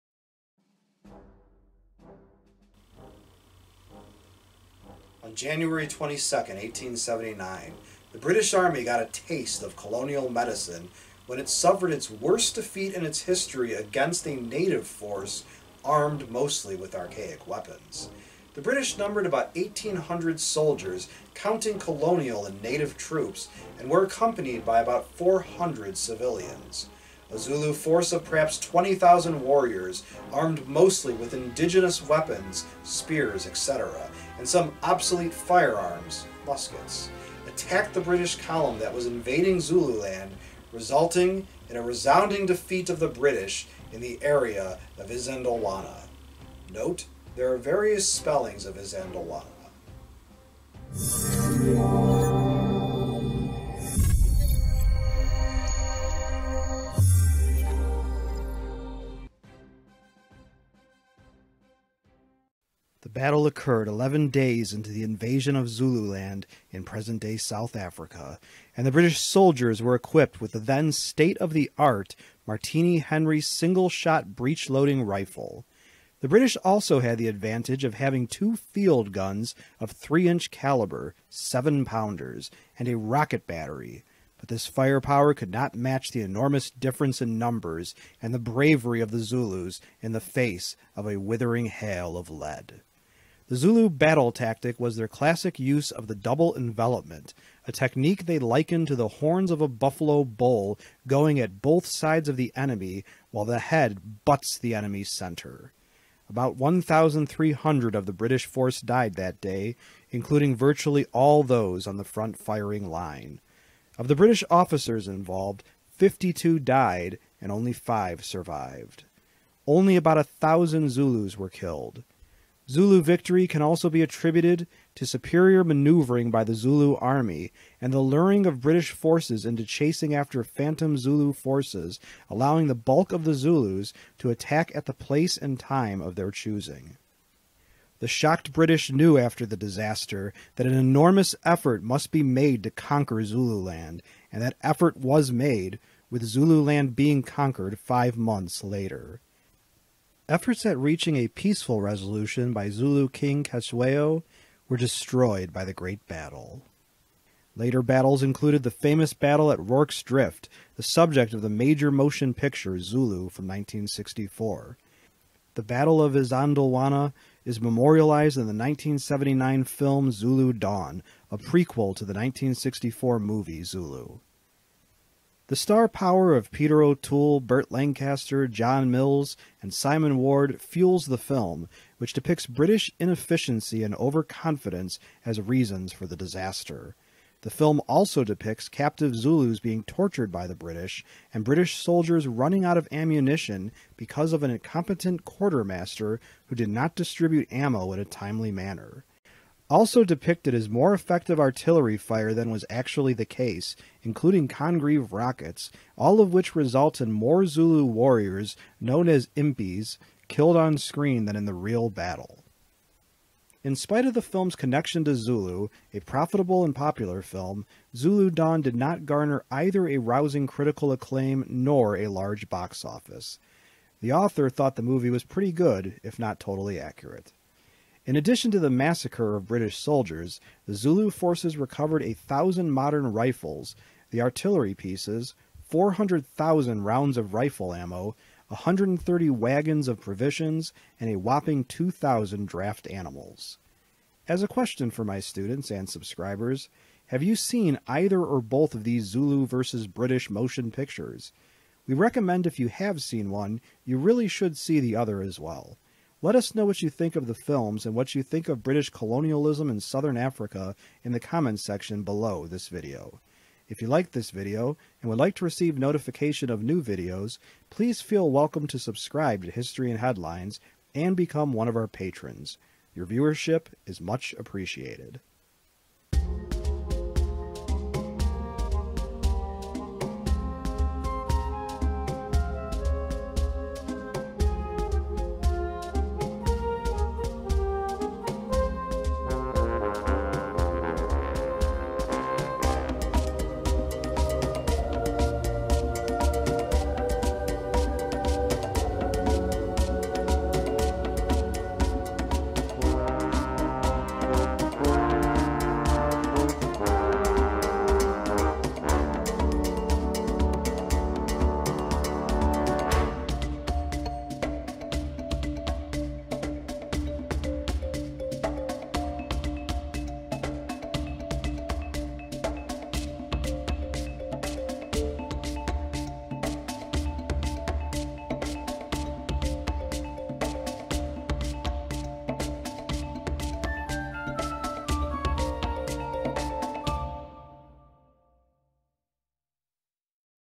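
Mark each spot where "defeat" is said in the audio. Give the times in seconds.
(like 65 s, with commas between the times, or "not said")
12 s, 42 s.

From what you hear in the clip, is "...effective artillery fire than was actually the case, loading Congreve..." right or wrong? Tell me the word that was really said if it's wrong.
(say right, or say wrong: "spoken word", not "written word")
wrong: "including", not "loading".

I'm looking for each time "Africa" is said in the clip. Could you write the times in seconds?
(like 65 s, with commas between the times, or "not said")
67 s, 260 s.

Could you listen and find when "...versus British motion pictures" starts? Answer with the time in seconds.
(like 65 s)
249 s.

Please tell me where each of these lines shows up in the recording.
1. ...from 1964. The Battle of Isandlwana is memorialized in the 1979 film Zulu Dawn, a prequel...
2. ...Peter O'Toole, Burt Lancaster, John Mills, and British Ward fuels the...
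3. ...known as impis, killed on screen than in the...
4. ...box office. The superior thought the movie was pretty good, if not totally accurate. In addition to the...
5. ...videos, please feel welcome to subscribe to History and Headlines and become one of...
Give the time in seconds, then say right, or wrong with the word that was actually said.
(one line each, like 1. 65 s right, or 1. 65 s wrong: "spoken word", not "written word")
1. 163 s right
2. 176 s wrong: "Simon", not "British"
3. 208 s right
4. 222 s wrong: "author", not "superior"
5. 266 s right.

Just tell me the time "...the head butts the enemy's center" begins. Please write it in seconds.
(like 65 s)
103 s.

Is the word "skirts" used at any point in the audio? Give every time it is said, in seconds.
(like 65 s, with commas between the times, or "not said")
not said.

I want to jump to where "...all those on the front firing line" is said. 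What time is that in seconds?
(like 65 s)
111 s.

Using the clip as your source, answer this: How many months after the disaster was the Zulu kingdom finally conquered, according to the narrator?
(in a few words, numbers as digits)
5.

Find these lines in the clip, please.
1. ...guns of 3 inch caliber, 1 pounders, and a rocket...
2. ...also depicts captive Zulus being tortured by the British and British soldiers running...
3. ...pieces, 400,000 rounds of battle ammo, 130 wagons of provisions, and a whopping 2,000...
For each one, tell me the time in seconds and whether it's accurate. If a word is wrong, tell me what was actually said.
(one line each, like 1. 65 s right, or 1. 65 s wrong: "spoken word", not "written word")
1. 79 s wrong: "7", not "1"
2. 187 s right
3. 234 s wrong: "rifle", not "battle".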